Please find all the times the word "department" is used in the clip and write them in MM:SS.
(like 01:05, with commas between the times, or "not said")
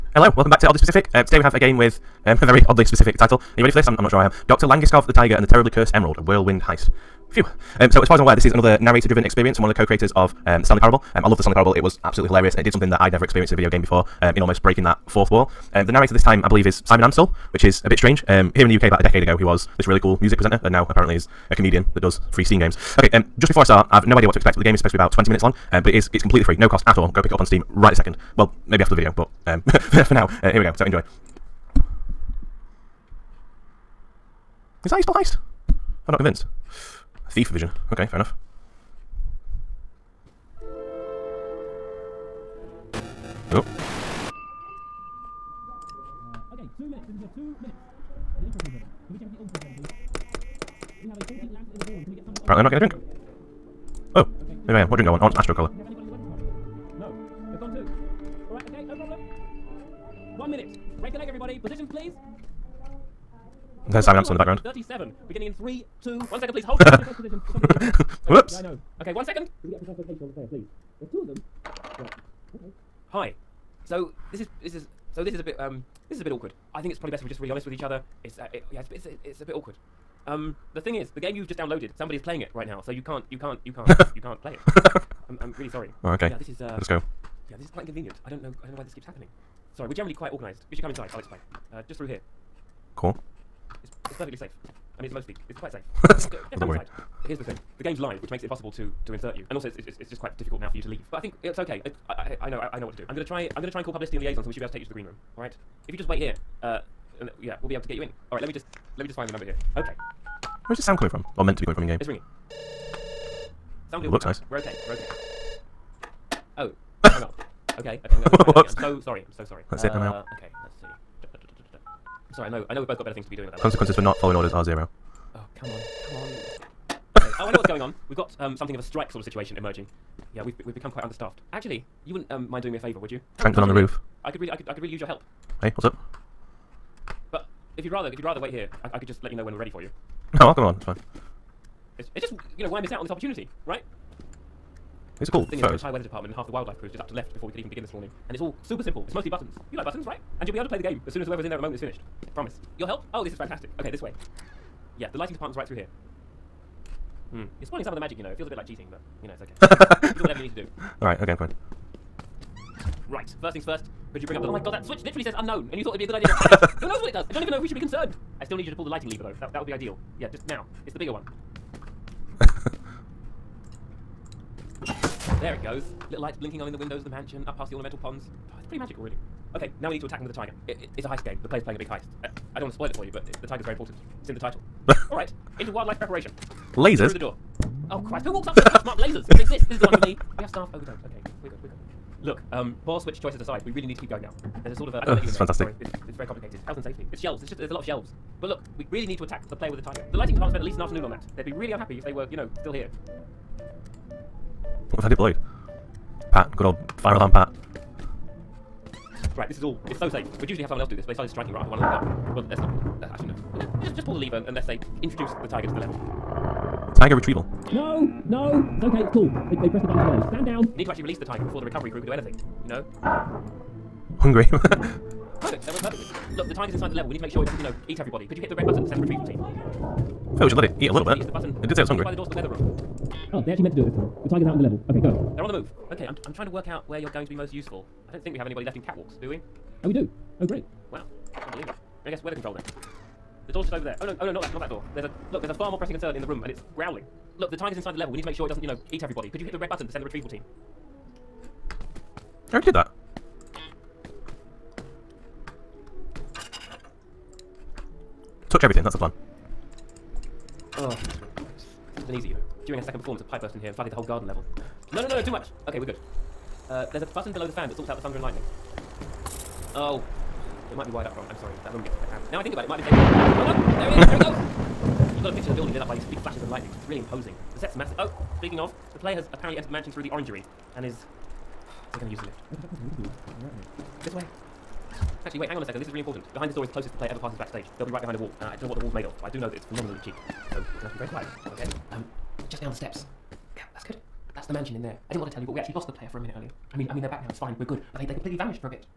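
02:26, 02:35, 03:20.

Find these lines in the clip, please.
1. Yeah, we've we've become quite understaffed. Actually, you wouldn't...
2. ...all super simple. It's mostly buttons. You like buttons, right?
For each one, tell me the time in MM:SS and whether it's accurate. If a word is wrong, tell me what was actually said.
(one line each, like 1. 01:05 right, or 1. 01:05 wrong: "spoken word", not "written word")
1. 02:10 right
2. 02:28 right.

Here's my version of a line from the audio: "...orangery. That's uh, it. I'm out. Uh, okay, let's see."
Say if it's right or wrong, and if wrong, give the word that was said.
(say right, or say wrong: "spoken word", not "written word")
wrong: "sorry", not "orangery".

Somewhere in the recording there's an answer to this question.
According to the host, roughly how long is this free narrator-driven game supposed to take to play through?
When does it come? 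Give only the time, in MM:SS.
00:25.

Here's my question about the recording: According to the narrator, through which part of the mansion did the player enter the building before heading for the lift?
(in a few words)
The orangery.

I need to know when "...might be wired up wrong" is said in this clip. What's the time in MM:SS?
04:30.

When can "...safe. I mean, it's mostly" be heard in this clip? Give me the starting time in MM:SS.
01:34.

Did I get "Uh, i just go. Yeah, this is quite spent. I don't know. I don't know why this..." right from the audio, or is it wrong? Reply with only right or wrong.
wrong.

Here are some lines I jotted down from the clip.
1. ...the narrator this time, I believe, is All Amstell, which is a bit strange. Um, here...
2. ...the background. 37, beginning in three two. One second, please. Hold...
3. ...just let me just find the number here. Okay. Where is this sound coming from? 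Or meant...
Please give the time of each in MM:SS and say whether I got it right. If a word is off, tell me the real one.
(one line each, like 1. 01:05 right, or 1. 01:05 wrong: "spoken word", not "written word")
1. 00:15 wrong: "Simon", not "All"
2. 01:04 right
3. 01:48 right.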